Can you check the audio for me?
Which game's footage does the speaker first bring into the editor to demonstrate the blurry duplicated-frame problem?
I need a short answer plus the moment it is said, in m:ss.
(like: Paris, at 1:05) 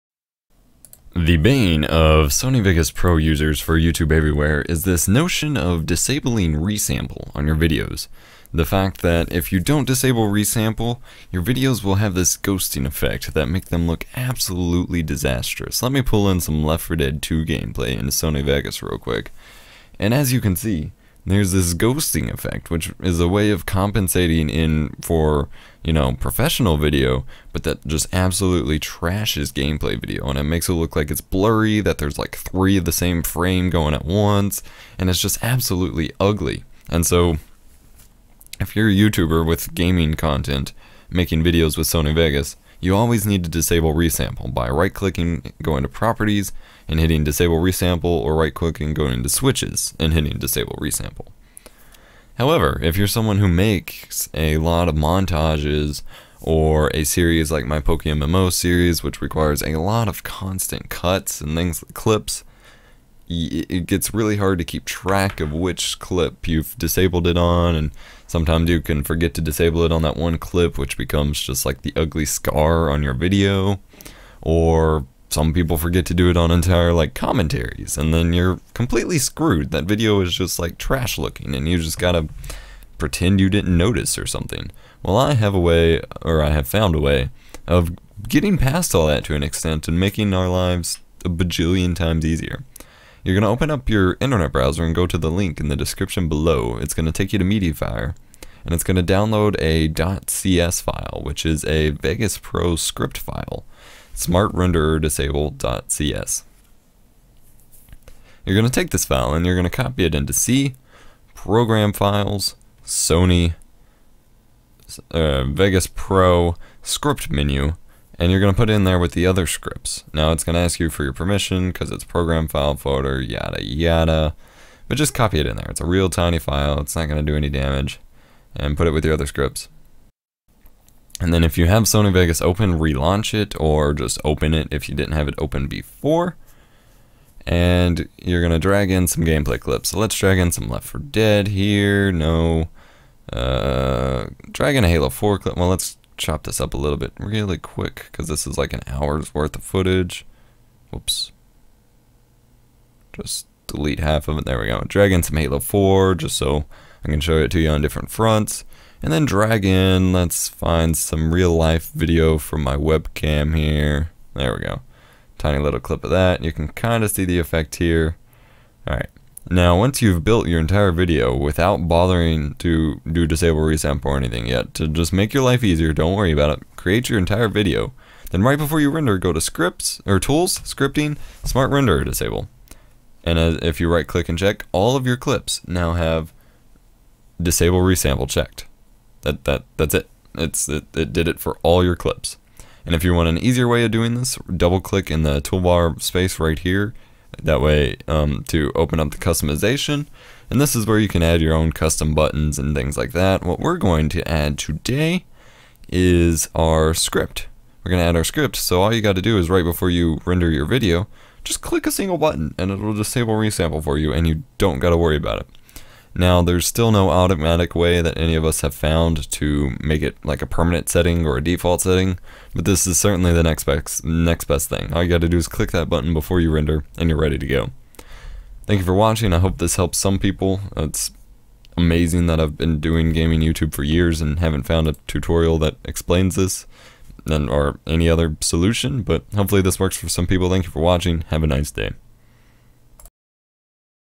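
Left 4 Dead 2, at 0:16.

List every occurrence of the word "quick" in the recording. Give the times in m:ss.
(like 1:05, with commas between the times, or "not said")
0:18, 2:27.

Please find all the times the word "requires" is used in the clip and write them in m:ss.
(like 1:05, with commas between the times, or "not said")
0:59.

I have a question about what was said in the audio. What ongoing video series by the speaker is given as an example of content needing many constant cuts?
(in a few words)
Pokemon MMO series.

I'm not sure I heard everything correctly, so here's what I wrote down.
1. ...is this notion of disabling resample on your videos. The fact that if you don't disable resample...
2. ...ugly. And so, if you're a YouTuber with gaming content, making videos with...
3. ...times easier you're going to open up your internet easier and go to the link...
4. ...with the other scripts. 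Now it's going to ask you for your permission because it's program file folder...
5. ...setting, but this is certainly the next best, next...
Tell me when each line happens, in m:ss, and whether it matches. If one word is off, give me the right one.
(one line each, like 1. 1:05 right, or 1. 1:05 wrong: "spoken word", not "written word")
1. 0:04 right
2. 0:36 right
3. 1:31 wrong: "browser", not "easier"
4. 1:58 right
5. 3:41 right.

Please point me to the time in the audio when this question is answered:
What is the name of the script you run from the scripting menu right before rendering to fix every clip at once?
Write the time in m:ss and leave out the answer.
3:01.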